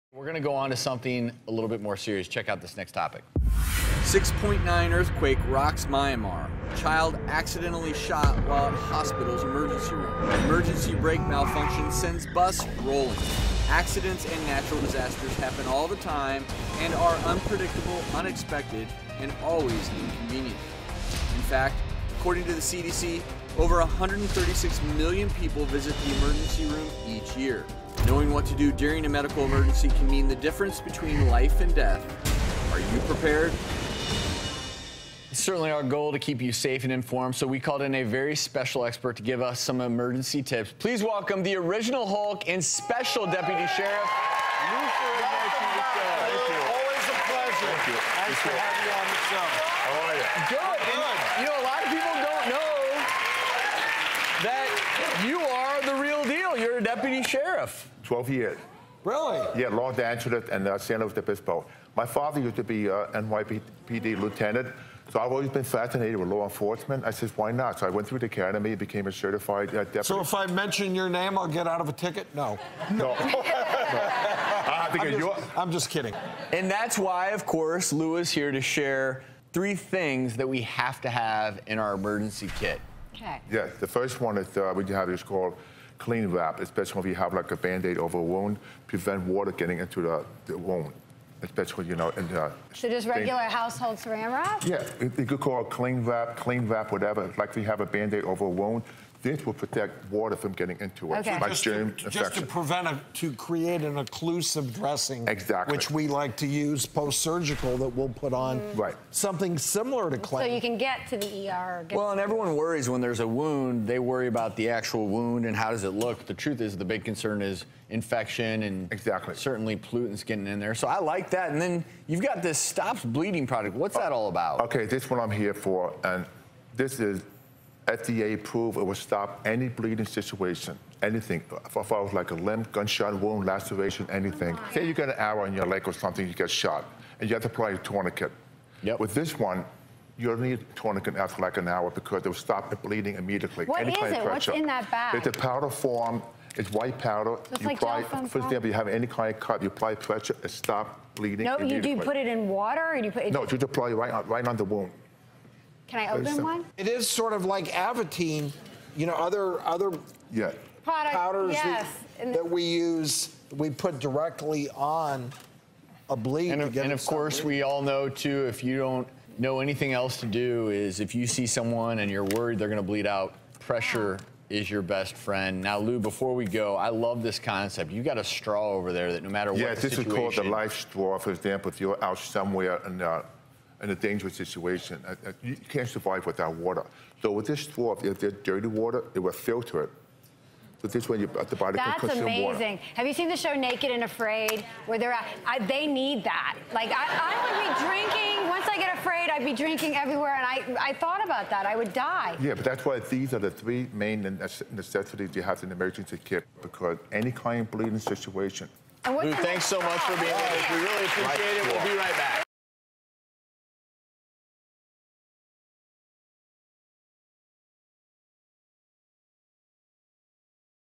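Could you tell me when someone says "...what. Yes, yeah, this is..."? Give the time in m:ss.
2:59.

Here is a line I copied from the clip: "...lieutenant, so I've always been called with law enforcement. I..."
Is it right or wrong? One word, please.
wrong.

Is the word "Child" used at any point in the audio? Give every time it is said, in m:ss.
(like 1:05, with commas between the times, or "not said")
0:06.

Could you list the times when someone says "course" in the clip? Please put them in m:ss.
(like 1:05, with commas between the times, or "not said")
1:17, 2:47.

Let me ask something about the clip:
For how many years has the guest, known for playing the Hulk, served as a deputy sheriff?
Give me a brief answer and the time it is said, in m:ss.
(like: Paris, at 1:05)
12 years, at 0:58.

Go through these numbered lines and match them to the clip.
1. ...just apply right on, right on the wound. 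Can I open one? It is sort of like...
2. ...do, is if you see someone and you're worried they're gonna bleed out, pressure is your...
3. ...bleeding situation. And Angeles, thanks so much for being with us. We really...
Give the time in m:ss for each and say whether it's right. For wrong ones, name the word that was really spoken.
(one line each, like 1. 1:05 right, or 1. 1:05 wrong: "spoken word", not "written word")
1. 2:33 right
2. 2:50 right
3. 3:27 wrong: "Lou", not "Angeles".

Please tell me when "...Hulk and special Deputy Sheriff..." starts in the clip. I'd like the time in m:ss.
0:42.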